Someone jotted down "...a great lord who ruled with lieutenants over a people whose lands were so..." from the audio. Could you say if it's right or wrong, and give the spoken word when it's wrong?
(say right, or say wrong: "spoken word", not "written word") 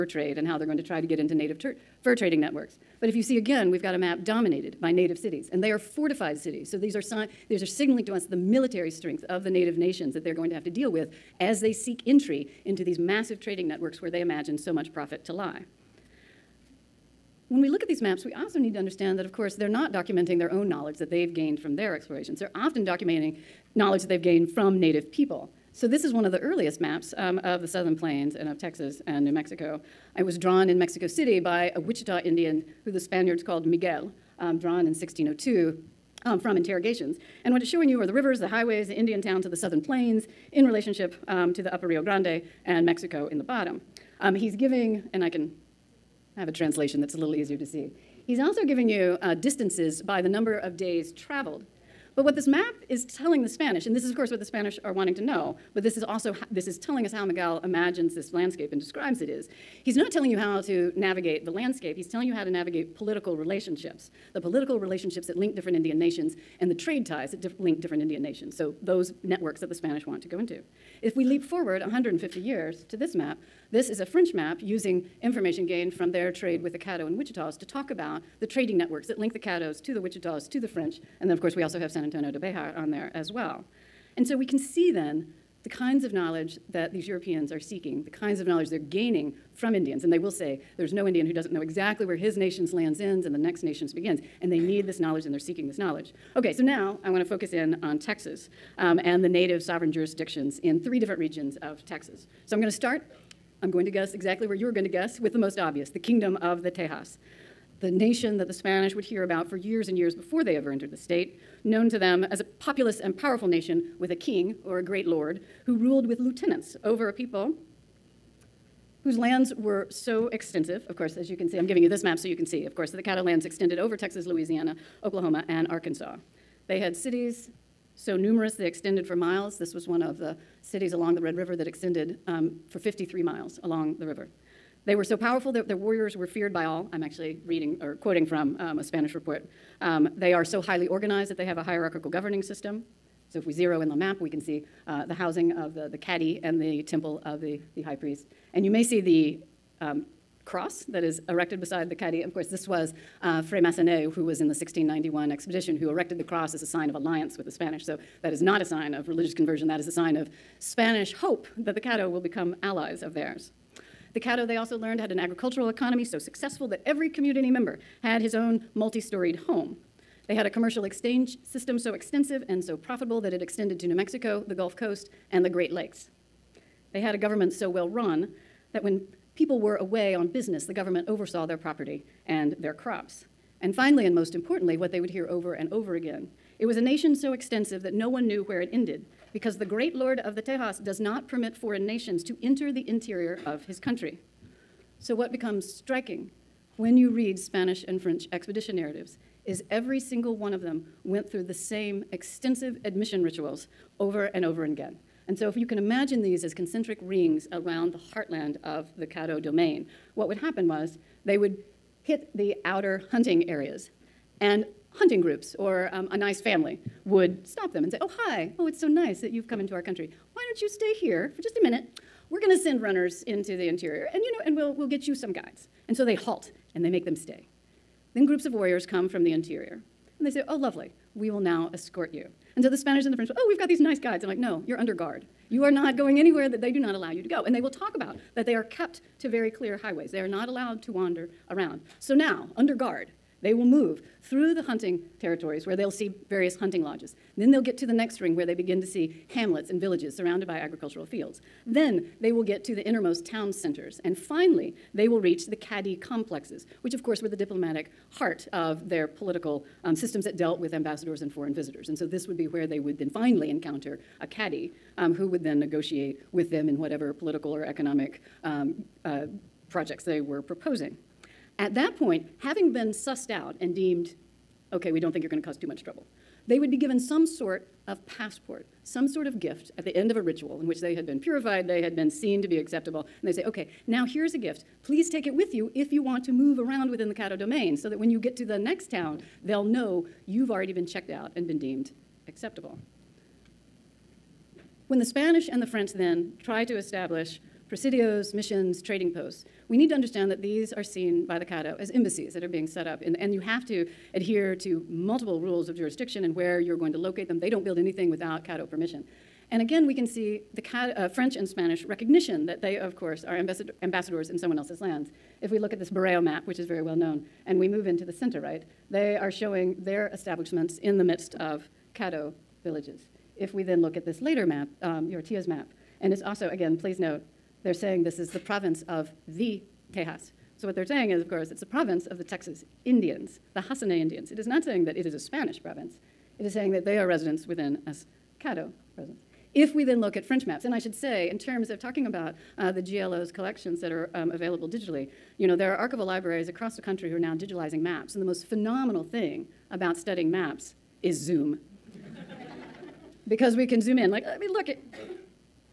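right.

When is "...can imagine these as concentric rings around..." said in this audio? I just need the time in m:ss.
3:25.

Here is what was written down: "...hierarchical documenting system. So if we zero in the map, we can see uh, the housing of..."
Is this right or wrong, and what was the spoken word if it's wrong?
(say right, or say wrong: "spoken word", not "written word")
wrong: "governing", not "documenting".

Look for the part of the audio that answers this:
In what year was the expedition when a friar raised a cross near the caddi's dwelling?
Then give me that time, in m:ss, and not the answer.
2:34.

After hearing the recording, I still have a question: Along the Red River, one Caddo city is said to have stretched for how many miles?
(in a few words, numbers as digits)
53.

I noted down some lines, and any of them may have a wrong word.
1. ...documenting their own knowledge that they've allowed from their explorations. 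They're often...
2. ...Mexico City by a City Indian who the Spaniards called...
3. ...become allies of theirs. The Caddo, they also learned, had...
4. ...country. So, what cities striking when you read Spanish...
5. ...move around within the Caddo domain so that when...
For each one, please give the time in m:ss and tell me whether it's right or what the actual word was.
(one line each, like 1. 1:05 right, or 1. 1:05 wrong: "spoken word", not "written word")
1. 0:19 wrong: "gained", not "allowed"
2. 0:30 wrong: "Wichita", not "City"
3. 2:42 right
4. 3:13 wrong: "becomes", not "cities"
5. 4:46 right.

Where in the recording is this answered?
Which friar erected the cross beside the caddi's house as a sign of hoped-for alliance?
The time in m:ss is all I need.
2:33.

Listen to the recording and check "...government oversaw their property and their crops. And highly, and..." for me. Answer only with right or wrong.
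wrong.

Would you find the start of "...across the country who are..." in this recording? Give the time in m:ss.
5:46.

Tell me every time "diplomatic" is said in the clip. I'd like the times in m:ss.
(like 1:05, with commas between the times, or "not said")
4:17.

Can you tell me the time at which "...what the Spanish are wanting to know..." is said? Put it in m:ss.
0:54.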